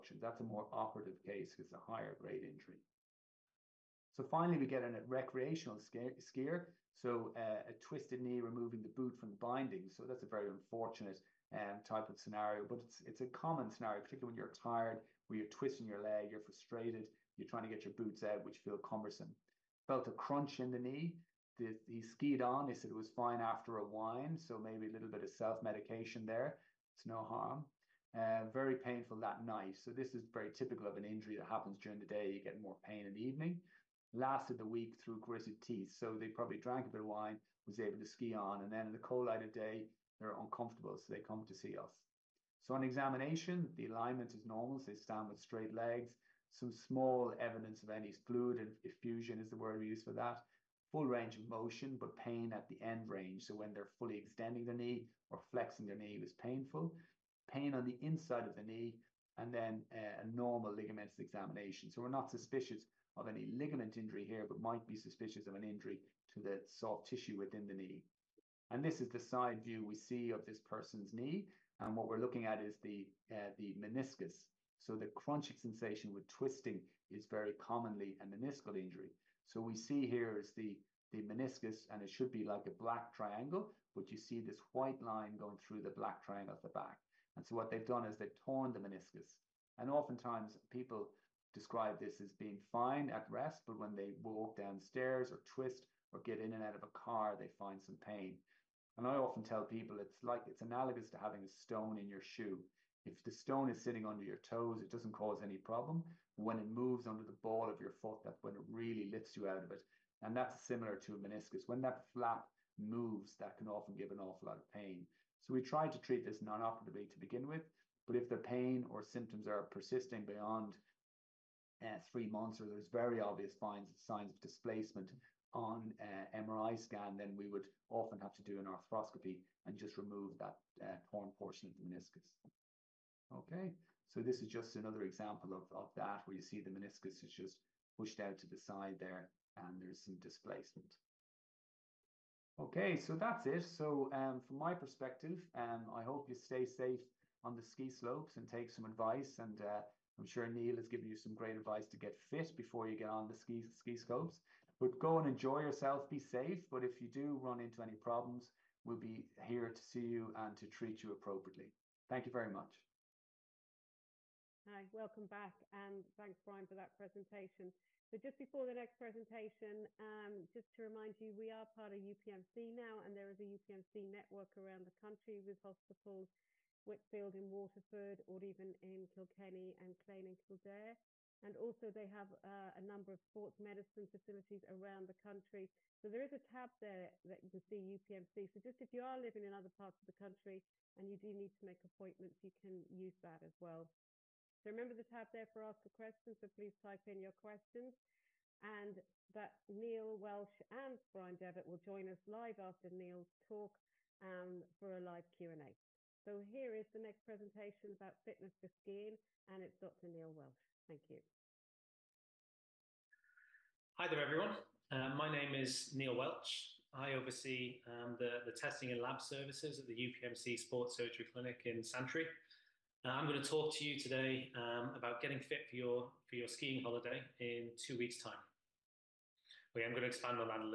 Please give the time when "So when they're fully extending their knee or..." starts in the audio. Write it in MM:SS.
00:53.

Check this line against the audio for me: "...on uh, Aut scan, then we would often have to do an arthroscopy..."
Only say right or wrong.
wrong.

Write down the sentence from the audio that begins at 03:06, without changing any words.
So there is a tab there that you can see UPMC.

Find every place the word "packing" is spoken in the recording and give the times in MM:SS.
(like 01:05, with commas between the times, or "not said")
not said.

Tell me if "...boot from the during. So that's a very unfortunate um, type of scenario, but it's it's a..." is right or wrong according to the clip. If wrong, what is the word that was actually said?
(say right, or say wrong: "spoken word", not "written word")
wrong: "binding", not "during".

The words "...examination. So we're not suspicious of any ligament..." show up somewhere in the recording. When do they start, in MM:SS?
01:01.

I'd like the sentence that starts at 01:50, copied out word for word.
And that's similar to a meniscus.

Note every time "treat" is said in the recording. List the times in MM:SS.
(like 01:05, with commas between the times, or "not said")
01:55, 02:40.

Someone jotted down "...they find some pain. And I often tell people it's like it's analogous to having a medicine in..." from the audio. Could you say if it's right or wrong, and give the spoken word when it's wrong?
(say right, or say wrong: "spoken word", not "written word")
wrong: "stone", not "medicine".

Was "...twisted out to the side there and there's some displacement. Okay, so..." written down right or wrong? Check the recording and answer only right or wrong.
wrong.